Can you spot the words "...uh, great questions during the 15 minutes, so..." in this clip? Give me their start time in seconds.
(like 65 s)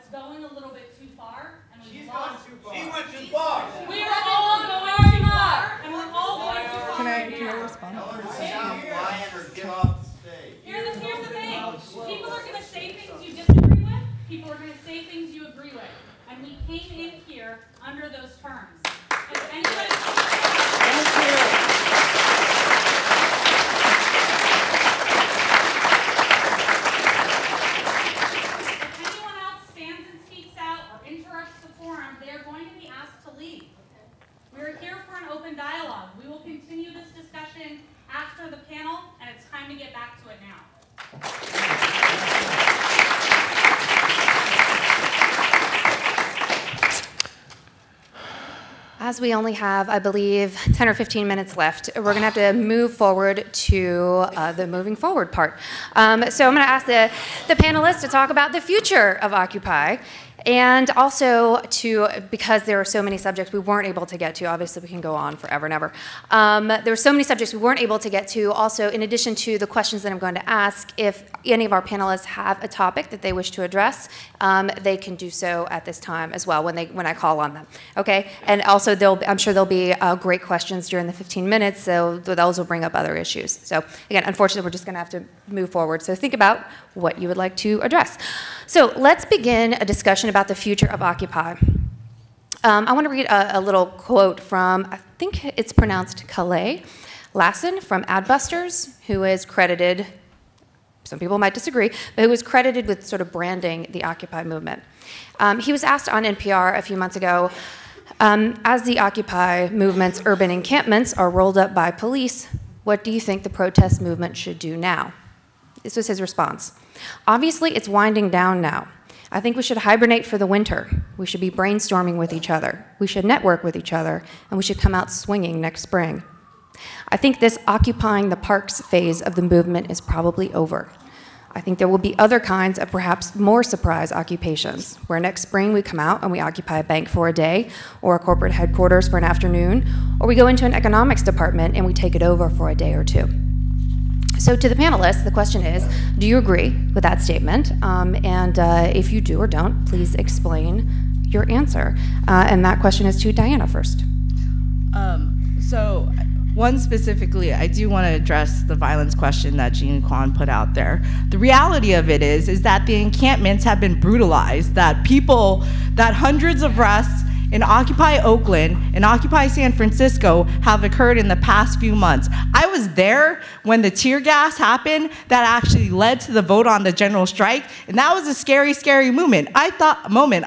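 79 s.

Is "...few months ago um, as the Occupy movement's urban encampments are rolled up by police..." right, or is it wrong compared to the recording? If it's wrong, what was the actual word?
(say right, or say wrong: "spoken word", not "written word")
right.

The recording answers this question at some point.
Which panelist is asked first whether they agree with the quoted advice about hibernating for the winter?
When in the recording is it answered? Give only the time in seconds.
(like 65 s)
153 s.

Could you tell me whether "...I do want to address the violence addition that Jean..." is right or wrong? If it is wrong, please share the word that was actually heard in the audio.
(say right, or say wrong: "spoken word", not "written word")
wrong: "question", not "addition".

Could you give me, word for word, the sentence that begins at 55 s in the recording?
Um, so I'm going to ask the, the panelists to talk about the future of Occupy.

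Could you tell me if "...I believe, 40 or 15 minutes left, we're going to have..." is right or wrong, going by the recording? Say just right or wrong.
wrong.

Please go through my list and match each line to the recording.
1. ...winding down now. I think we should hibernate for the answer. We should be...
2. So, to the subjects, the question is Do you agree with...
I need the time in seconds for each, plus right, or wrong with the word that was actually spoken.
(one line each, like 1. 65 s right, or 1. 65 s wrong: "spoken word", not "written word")
1. 117 s wrong: "winter", not "answer"
2. 144 s wrong: "panelists", not "subjects".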